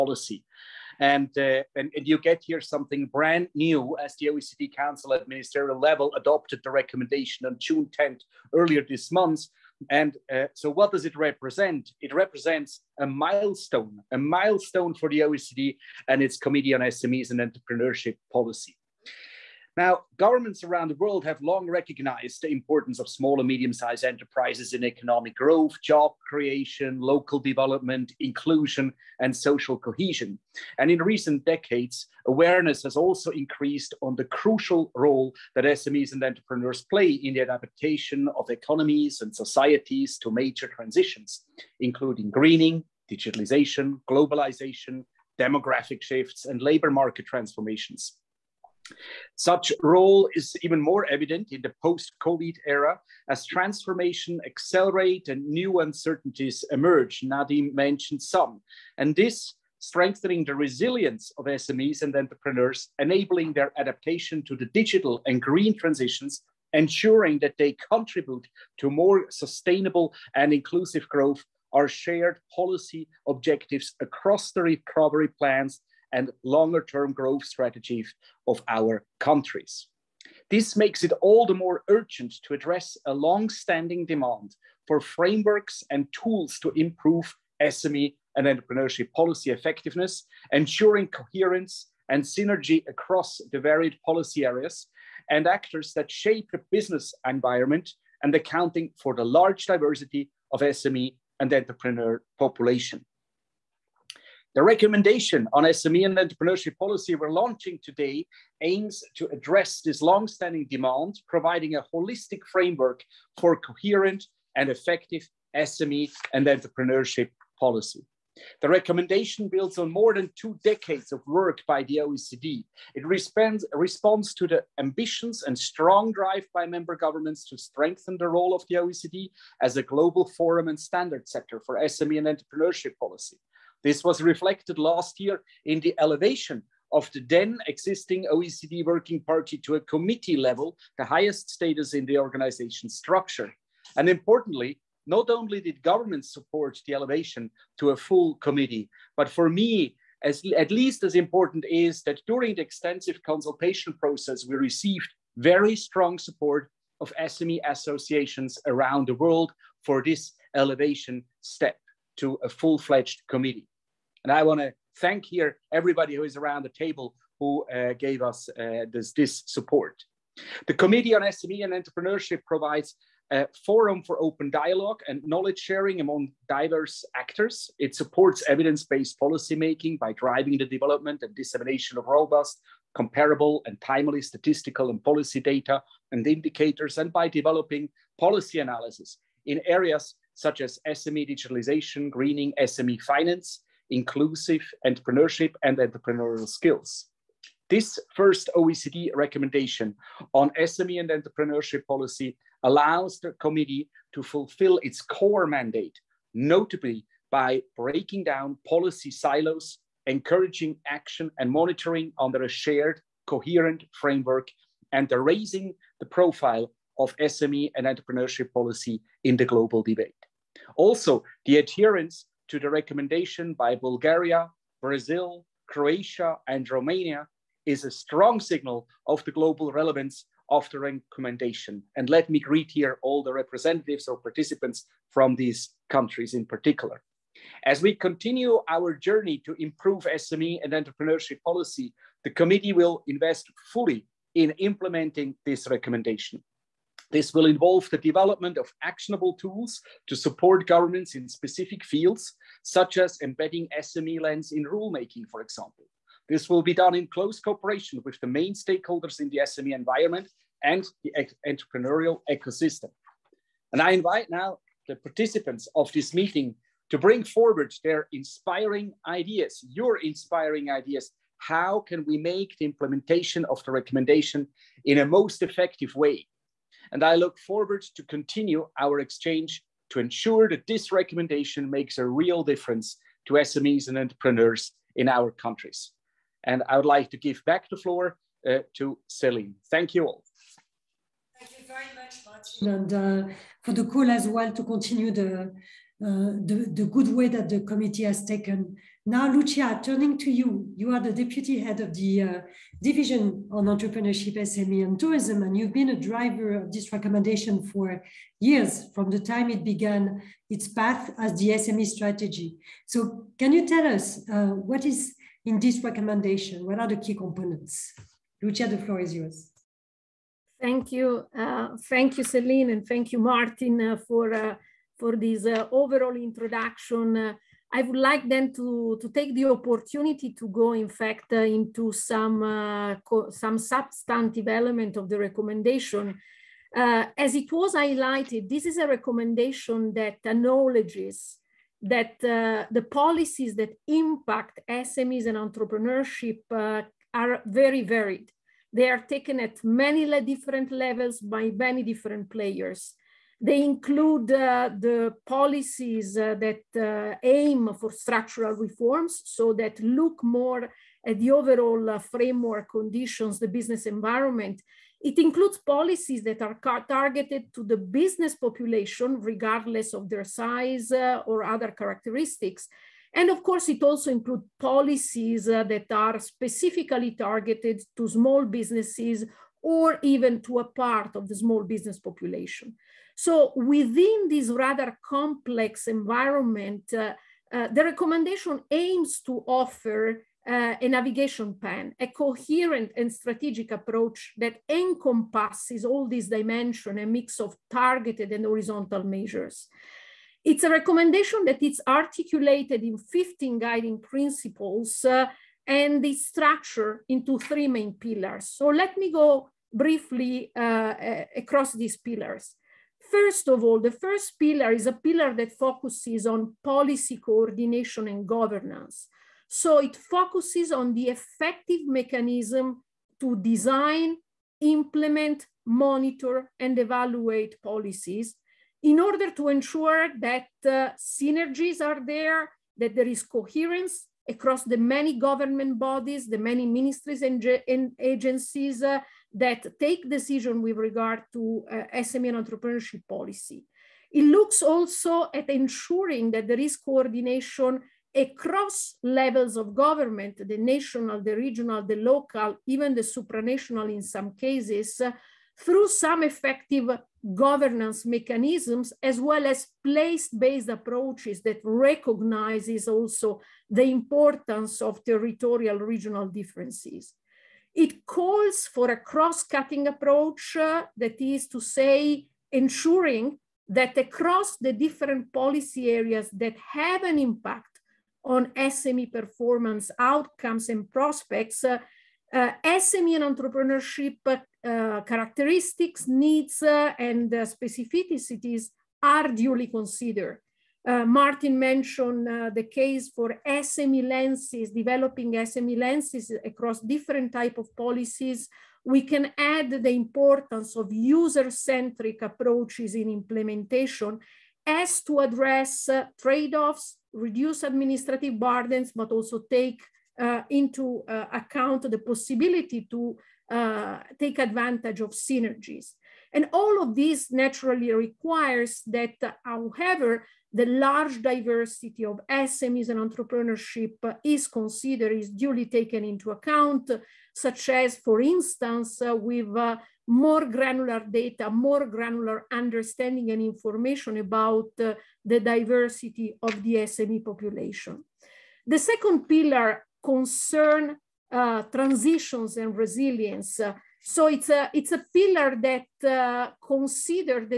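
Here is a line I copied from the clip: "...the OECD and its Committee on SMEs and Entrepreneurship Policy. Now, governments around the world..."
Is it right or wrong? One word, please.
right.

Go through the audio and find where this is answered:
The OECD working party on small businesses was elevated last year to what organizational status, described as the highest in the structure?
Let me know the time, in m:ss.
2:19.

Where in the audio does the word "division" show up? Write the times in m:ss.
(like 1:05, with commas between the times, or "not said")
5:02.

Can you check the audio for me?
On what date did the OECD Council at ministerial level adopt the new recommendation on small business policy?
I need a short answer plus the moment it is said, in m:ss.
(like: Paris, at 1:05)
June 10th, at 0:07.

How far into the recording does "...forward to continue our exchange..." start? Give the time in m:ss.
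4:37.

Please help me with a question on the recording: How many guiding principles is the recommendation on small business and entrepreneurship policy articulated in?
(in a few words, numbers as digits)
15.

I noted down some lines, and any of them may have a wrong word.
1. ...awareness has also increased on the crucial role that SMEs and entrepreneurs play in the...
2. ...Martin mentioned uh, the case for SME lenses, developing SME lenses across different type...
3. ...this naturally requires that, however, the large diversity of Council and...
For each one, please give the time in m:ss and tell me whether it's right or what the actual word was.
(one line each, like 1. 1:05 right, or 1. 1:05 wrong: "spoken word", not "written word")
1. 0:32 right
2. 8:11 right
3. 8:36 wrong: "SMEs", not "Council".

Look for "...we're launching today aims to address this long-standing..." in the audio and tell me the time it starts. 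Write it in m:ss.
1:47.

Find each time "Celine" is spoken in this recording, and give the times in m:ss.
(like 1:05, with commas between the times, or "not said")
4:49, 5:22.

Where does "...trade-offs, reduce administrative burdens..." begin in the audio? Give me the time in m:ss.
8:26.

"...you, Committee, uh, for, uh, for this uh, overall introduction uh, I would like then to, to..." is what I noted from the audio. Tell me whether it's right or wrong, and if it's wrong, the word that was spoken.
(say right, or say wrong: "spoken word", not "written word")
wrong: "Martin", not "Committee".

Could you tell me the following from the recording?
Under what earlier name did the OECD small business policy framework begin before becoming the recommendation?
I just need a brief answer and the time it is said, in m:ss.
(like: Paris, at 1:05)
SME strategy, at 5:11.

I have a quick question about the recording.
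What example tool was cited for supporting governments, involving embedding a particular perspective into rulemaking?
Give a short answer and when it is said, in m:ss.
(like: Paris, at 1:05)
SME lens, at 4:13.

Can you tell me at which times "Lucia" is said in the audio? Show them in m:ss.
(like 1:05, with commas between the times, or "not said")
4:59, 5:18.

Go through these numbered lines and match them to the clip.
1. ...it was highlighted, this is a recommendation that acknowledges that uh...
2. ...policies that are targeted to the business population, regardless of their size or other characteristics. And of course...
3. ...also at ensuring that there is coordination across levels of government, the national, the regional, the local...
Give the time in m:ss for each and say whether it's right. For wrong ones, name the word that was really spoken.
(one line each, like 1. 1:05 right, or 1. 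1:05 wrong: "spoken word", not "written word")
1. 5:37 right
2. 6:05 right
3. 7:24 right.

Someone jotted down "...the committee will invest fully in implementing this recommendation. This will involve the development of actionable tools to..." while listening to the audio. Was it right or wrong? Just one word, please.
right.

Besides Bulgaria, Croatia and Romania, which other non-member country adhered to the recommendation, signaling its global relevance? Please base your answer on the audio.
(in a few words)
Brazil.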